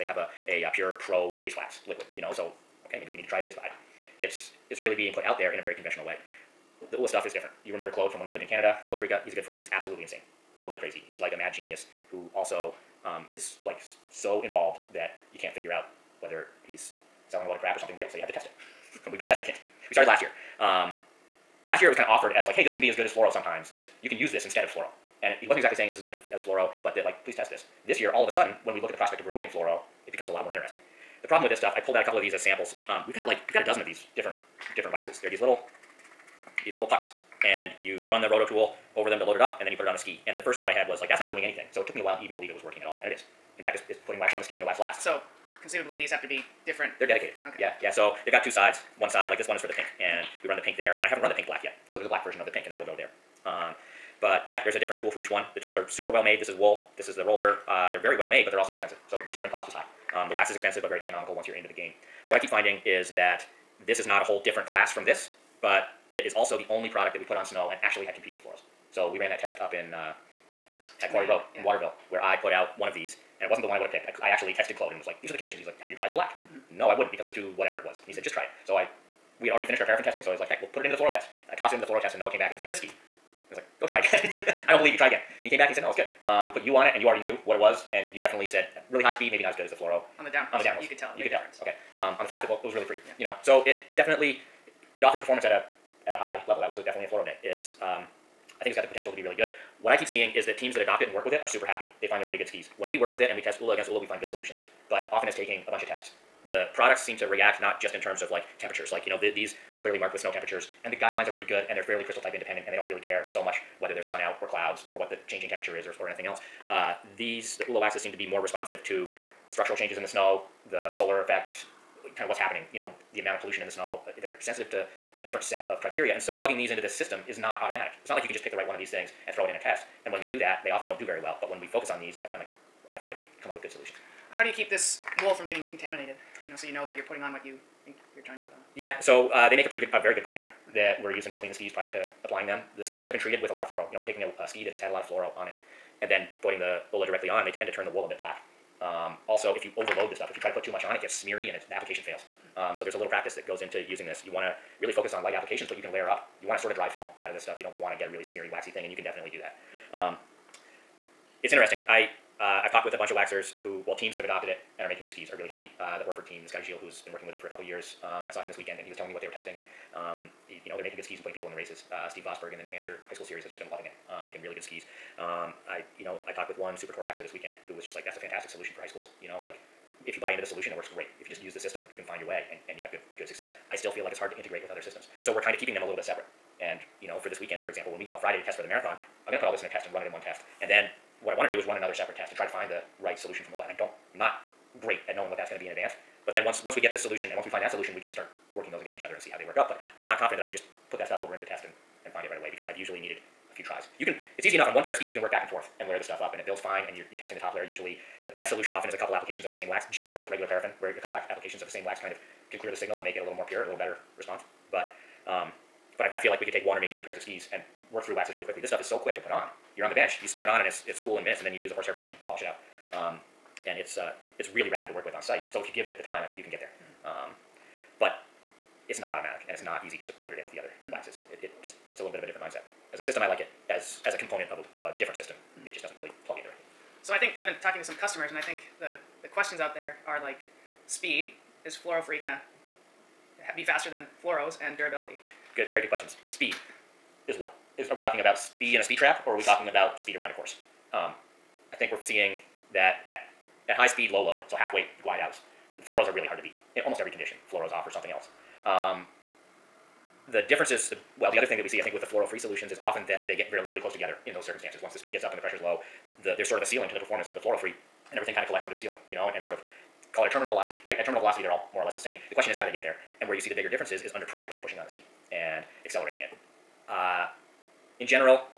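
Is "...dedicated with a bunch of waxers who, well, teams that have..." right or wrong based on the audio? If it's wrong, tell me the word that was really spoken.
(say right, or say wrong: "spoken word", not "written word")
wrong: "talked", not "dedicated".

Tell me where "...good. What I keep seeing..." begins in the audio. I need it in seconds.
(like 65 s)
99 s.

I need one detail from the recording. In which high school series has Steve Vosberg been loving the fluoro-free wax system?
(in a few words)
New Hampshire High School Series.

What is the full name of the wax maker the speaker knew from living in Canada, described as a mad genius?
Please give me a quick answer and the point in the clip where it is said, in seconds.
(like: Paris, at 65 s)
Claude Prika, at 8 s.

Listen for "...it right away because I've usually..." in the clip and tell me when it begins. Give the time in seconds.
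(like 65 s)
202 s.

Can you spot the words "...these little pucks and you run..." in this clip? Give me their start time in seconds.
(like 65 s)
36 s.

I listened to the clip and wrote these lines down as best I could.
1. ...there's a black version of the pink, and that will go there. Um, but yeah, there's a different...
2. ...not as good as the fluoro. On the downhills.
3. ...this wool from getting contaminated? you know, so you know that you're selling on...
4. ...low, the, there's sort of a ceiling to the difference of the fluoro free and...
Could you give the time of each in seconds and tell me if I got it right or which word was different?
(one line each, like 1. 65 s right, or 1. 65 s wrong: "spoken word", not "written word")
1. 51 s right
2. 89 s right
3. 134 s wrong: "putting", not "selling"
4. 265 s wrong: "performance", not "difference".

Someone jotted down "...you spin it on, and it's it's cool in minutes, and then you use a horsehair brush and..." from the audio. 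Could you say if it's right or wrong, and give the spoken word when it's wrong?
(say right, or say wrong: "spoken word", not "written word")
right.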